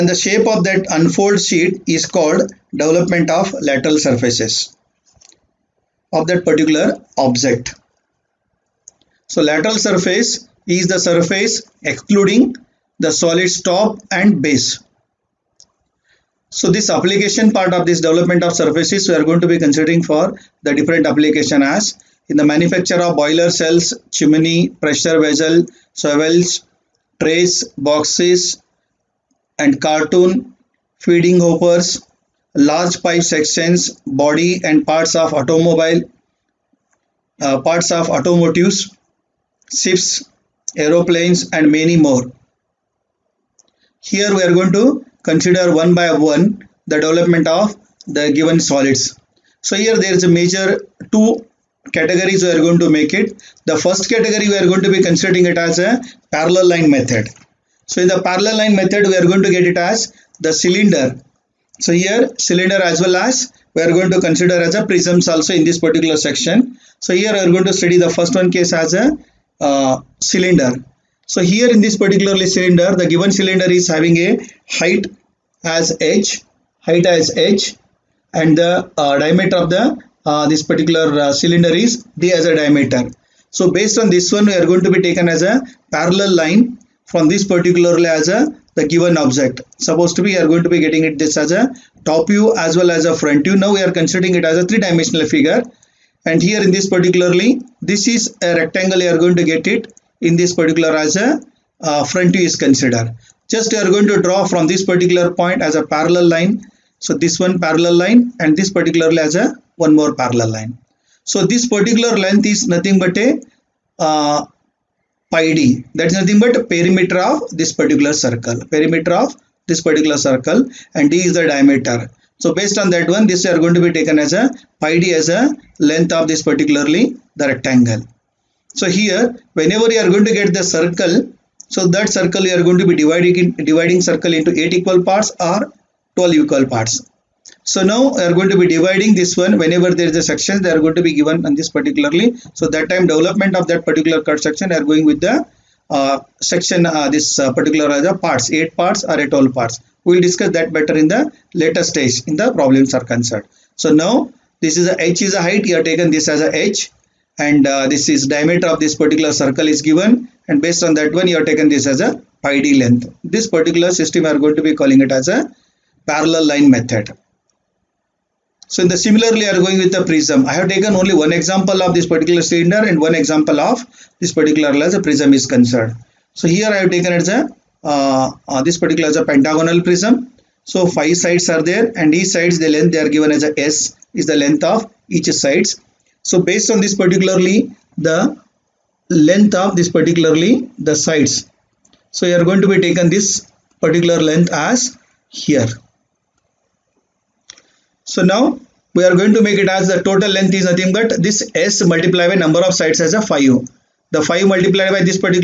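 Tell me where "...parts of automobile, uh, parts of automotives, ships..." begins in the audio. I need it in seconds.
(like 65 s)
34 s.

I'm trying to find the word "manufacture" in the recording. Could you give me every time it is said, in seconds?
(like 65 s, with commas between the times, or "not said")
22 s.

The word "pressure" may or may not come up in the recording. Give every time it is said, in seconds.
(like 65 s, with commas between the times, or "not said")
24 s.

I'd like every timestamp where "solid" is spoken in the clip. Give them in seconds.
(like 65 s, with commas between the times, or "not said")
13 s, 48 s.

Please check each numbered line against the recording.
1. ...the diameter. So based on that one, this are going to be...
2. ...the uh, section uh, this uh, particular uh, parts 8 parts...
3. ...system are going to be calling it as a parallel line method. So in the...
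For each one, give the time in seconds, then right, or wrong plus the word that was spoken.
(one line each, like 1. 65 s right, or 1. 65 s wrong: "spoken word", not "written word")
1. 121 s right
2. 145 s right
3. 163 s right.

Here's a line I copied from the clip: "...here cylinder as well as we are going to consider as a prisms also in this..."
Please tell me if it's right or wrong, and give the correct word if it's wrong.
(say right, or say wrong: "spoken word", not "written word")
right.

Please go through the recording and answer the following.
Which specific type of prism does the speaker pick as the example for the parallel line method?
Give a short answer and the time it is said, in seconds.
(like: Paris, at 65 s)
Pentagonal prism, at 179 s.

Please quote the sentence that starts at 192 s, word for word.
So you are going to be taken this particular length as here.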